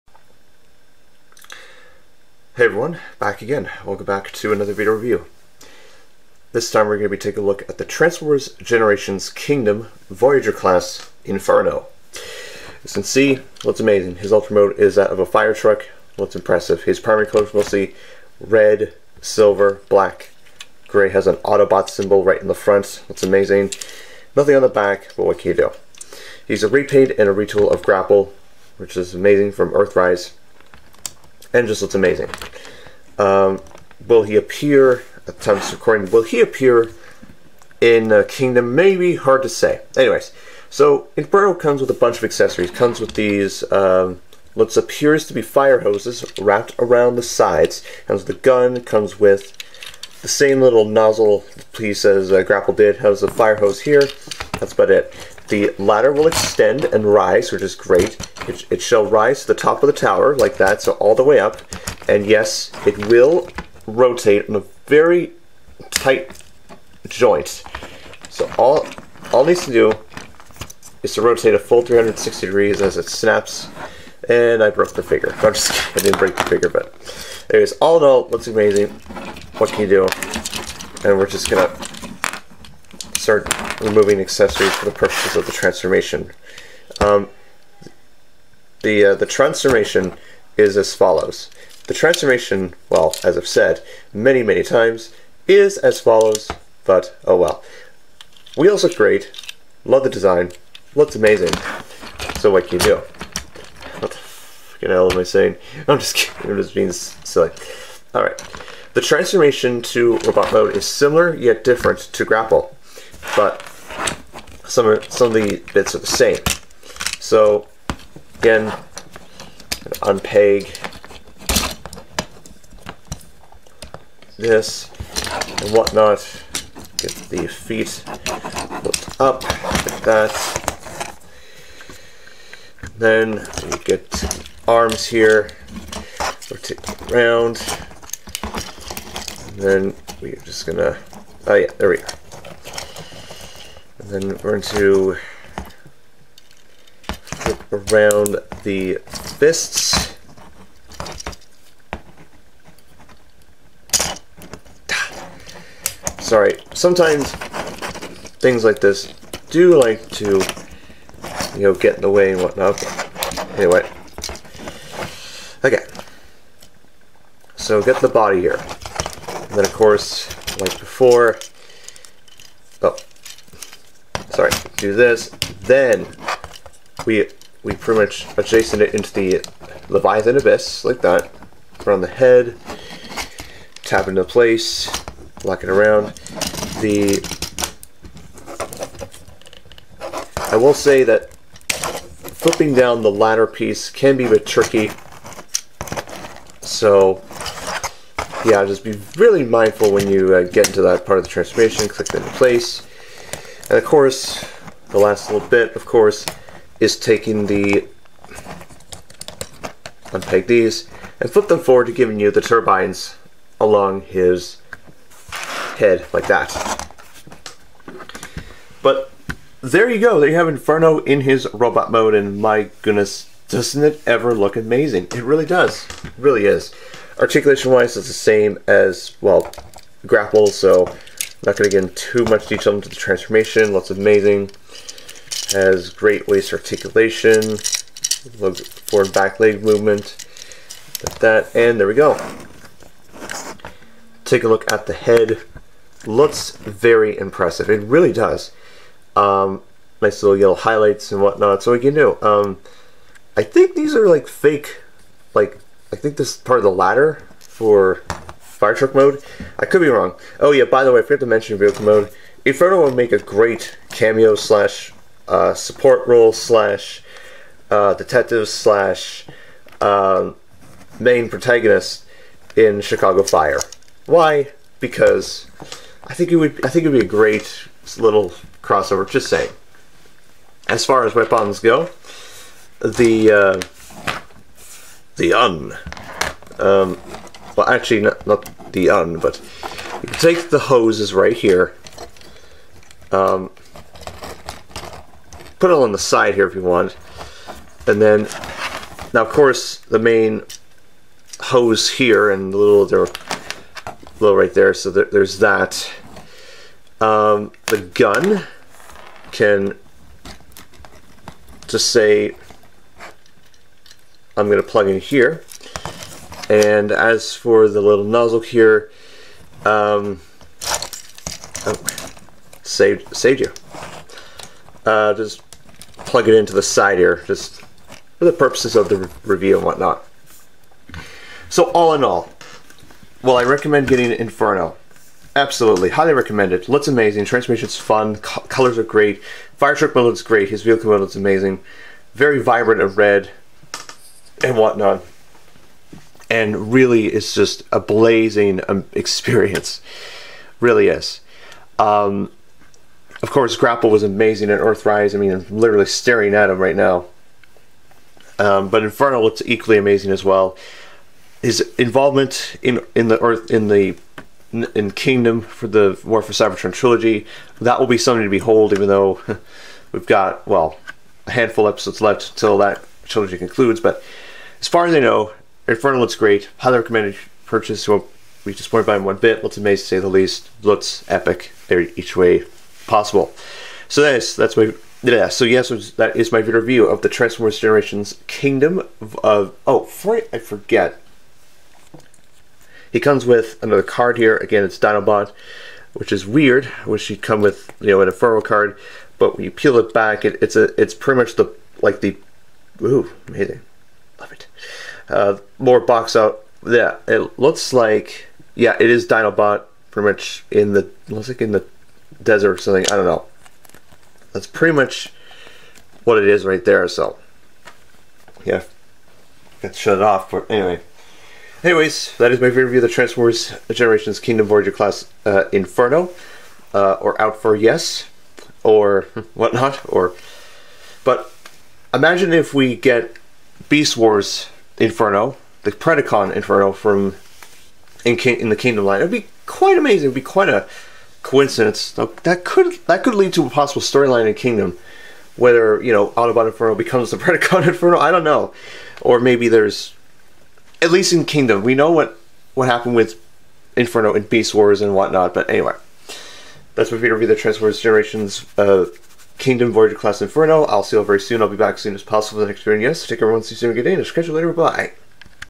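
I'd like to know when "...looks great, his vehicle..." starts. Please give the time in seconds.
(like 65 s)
340 s.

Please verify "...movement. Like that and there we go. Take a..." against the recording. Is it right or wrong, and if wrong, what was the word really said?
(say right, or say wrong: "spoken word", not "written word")
right.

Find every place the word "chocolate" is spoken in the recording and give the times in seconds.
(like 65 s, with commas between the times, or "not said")
not said.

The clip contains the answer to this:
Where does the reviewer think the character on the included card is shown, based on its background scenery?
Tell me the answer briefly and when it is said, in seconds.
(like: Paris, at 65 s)
the desert, at 411 s.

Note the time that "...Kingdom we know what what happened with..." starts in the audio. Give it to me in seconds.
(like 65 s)
451 s.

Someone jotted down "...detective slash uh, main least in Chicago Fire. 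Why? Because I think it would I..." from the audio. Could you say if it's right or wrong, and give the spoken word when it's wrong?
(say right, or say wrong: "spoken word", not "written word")
wrong: "protagonist", not "least".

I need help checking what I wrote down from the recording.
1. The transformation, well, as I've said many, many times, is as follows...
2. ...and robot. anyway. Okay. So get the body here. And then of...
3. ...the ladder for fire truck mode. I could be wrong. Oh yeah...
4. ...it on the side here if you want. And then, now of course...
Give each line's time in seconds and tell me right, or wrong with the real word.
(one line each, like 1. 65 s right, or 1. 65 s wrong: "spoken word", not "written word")
1. 91 s right
2. 162 s wrong: "whatnot", not "robot"
3. 256 s right
4. 295 s right.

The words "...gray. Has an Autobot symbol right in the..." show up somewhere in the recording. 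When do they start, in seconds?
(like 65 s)
20 s.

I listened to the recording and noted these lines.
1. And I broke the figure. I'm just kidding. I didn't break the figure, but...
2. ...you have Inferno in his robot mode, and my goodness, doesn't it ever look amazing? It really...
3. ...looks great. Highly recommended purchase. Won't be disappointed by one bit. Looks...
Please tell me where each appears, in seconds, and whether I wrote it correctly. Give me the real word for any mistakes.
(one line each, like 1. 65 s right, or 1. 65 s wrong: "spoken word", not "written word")
1. 74 s right
2. 220 s right
3. 375 s right.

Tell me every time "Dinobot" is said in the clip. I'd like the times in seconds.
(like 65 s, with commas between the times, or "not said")
394 s, 409 s.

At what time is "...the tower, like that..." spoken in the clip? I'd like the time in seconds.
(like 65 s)
59 s.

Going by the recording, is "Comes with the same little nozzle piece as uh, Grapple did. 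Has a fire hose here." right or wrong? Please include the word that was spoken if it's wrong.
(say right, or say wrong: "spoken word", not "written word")
right.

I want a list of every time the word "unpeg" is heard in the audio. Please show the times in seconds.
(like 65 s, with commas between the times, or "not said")
120 s, 210 s.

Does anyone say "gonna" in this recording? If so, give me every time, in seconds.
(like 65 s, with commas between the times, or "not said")
81 s, 140 s.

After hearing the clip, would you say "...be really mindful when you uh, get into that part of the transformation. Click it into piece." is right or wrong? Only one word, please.
wrong.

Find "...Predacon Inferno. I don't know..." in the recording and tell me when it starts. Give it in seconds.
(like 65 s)
447 s.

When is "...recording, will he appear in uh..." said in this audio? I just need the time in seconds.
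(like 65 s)
35 s.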